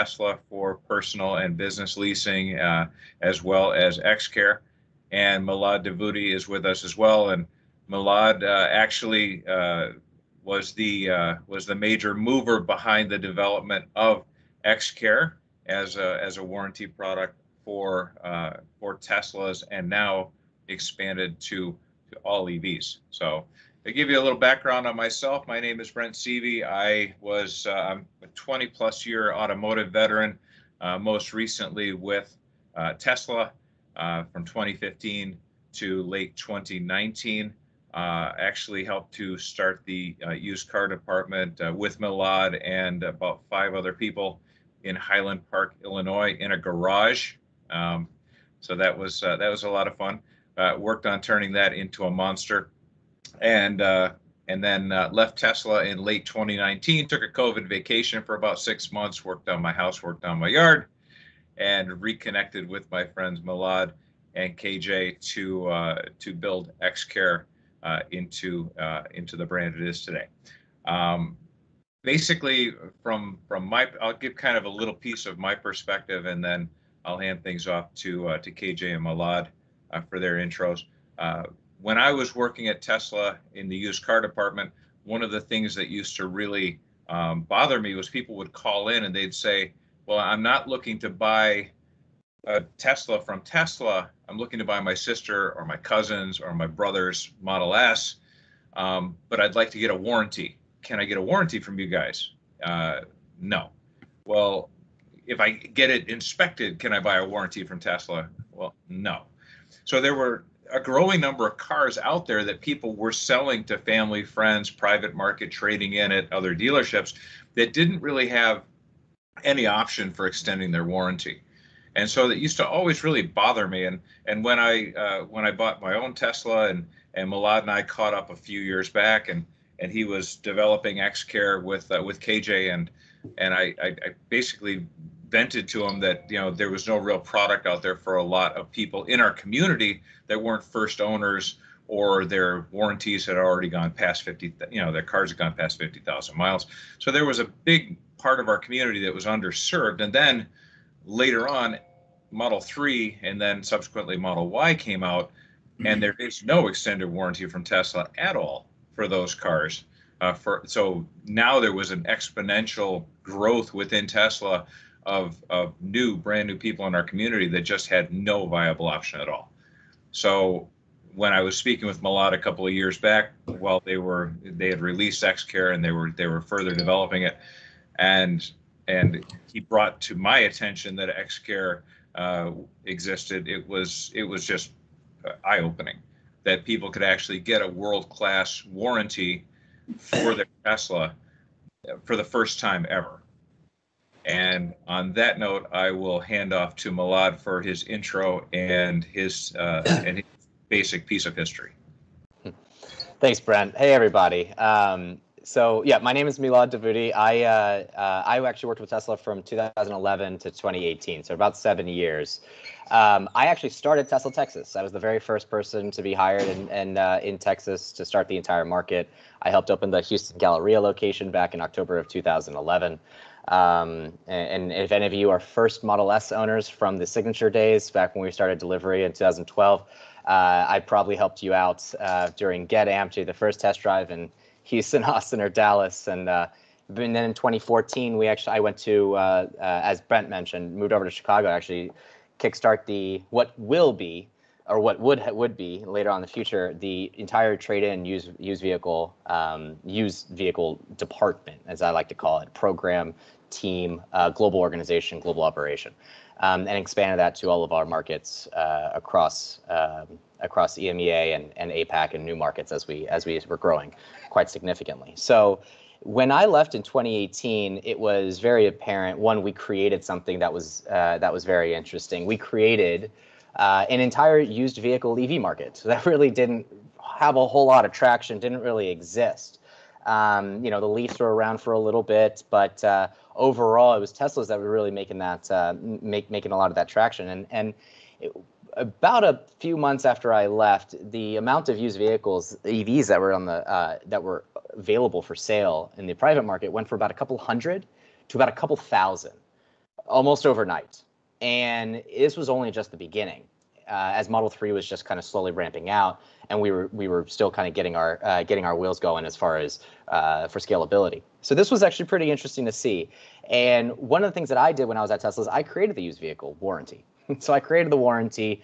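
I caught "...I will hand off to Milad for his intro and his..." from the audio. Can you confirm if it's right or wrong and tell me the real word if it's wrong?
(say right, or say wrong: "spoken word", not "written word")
right.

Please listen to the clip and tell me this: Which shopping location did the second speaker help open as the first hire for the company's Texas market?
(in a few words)
Houston Galleria.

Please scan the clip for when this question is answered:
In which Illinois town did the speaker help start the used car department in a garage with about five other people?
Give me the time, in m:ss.
0:44.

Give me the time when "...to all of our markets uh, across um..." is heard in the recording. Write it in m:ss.
4:17.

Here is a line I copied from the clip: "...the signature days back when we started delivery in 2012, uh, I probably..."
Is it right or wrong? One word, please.
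right.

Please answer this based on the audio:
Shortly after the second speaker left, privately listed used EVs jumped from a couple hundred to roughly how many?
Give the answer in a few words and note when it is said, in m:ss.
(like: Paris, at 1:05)
a couple thousand, at 4:58.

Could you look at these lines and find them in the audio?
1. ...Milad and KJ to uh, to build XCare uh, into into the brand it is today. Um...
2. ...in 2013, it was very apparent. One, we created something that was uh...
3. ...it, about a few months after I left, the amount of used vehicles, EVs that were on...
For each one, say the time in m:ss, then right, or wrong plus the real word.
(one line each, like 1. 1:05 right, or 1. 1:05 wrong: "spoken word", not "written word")
1. 1:03 right
2. 4:26 wrong: "2018", not "2013"
3. 4:48 right.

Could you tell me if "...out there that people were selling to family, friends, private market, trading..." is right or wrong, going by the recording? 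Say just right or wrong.
right.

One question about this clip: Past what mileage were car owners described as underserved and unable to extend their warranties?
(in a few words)
50,000 miles.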